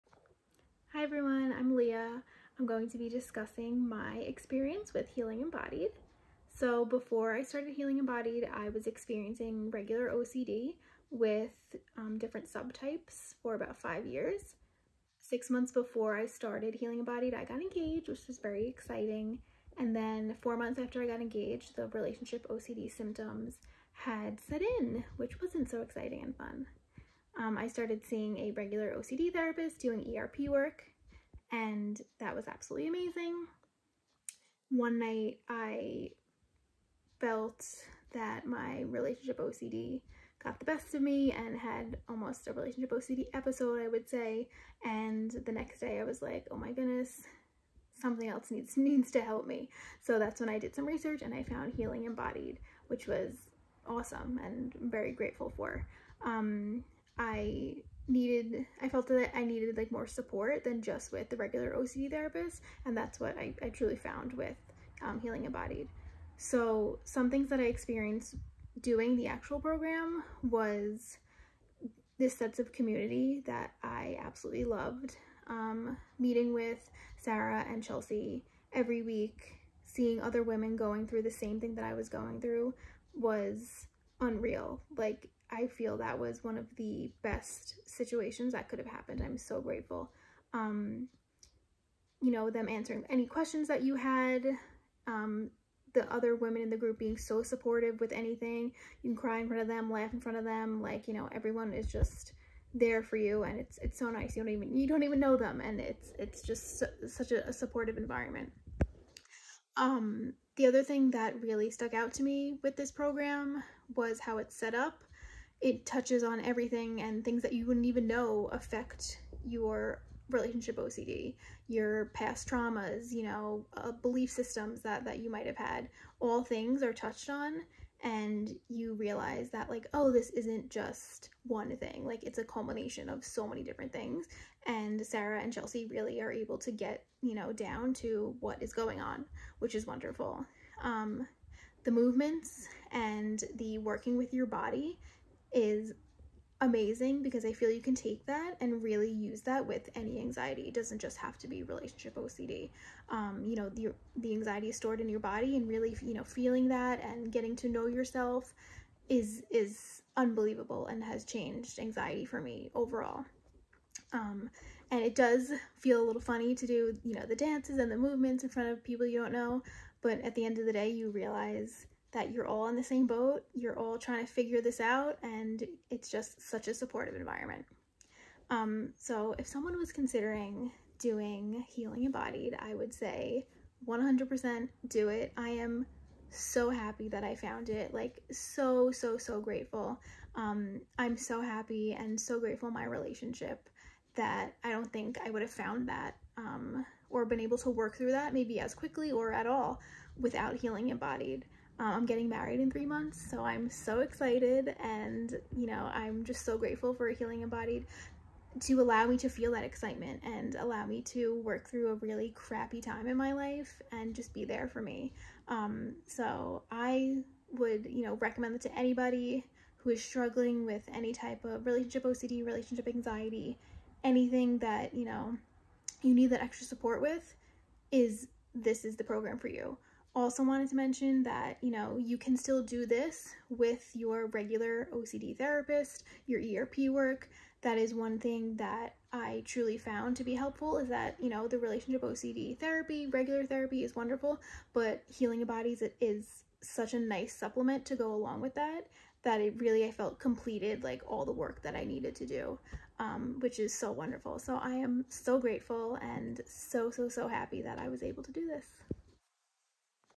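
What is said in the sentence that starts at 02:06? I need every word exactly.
All things are touched on and you realize that like, oh, this isn't just one thing.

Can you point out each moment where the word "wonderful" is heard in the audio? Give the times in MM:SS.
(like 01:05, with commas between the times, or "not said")
02:19, 04:03, 04:13.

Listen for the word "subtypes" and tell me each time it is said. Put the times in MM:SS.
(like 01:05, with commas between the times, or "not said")
00:12.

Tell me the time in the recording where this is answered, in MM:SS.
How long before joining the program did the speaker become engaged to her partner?
00:15.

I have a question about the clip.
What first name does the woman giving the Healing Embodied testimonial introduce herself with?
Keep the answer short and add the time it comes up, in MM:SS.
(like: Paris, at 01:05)
Lea, at 00:01.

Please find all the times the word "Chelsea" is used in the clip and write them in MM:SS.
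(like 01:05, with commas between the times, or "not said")
01:17, 02:15.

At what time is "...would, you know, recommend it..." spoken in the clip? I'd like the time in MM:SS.
03:37.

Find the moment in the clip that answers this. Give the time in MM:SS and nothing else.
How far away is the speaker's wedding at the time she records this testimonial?
03:22.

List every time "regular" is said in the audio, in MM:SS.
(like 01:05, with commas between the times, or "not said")
00:09, 00:28, 01:01, 03:54, 04:03.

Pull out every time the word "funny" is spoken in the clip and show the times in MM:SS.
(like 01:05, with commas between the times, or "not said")
02:46.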